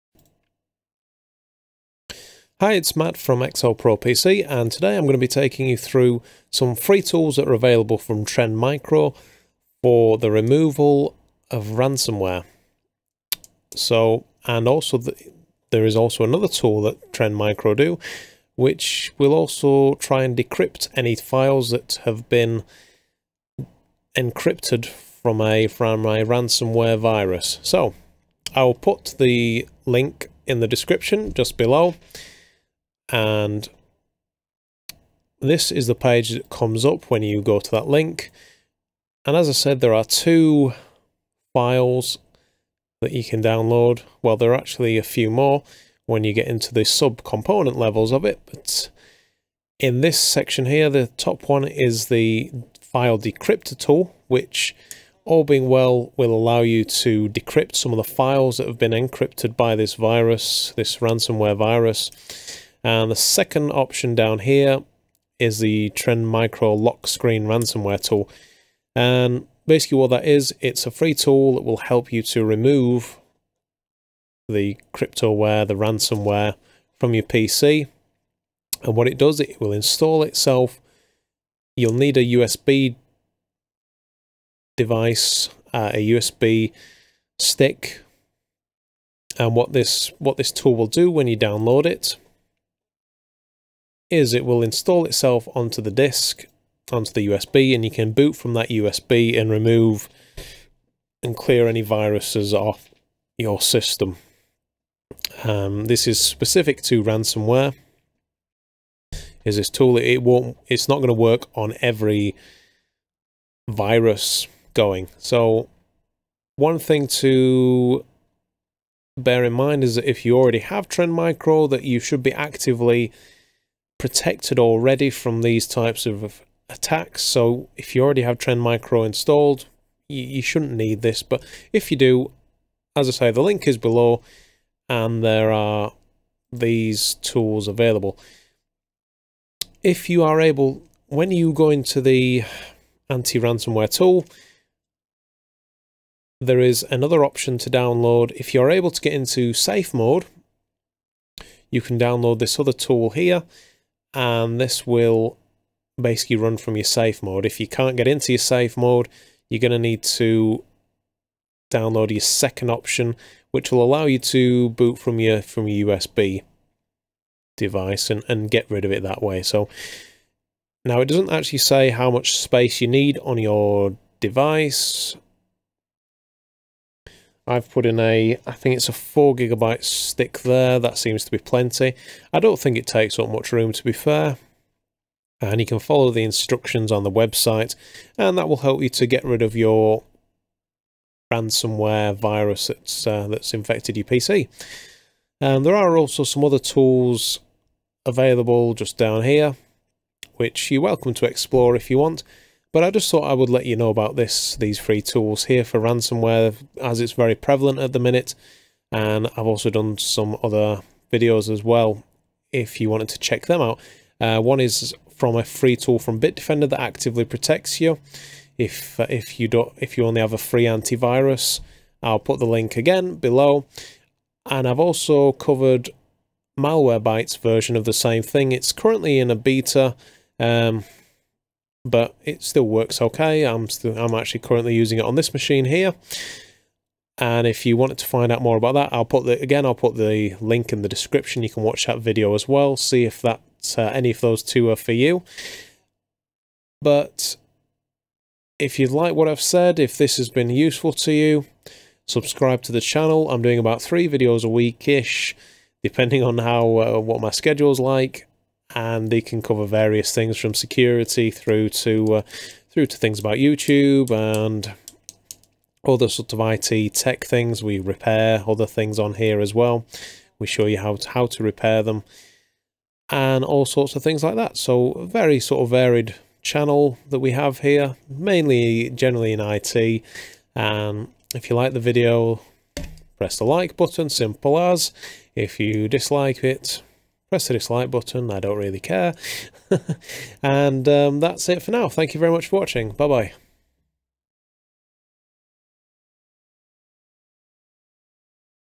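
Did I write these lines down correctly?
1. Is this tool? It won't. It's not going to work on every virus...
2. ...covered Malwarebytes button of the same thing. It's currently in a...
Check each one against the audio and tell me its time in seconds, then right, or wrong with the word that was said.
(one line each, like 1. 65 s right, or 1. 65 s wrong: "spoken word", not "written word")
1. 109 s right
2. 225 s wrong: "version", not "button".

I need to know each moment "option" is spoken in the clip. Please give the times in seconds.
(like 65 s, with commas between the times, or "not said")
63 s, 147 s, 162 s.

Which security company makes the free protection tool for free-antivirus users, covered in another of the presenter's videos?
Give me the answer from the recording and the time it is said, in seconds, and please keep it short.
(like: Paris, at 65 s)
Bitdefender, at 216 s.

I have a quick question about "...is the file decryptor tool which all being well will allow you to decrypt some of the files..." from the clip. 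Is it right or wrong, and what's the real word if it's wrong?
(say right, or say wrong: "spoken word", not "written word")
right.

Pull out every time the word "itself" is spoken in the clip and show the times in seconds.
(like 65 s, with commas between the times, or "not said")
80 s, 95 s.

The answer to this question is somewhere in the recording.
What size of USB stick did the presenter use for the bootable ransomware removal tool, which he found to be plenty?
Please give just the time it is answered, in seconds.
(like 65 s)
178 s.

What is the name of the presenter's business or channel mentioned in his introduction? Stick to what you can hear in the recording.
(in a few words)
XL Pro PC.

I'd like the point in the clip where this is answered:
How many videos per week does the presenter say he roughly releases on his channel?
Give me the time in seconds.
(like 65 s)
253 s.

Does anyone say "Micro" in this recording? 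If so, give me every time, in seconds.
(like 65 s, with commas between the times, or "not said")
8 s, 17 s, 66 s, 121 s, 128 s.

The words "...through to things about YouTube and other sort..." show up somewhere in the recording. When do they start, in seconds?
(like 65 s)
262 s.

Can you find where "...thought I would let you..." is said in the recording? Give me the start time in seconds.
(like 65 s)
203 s.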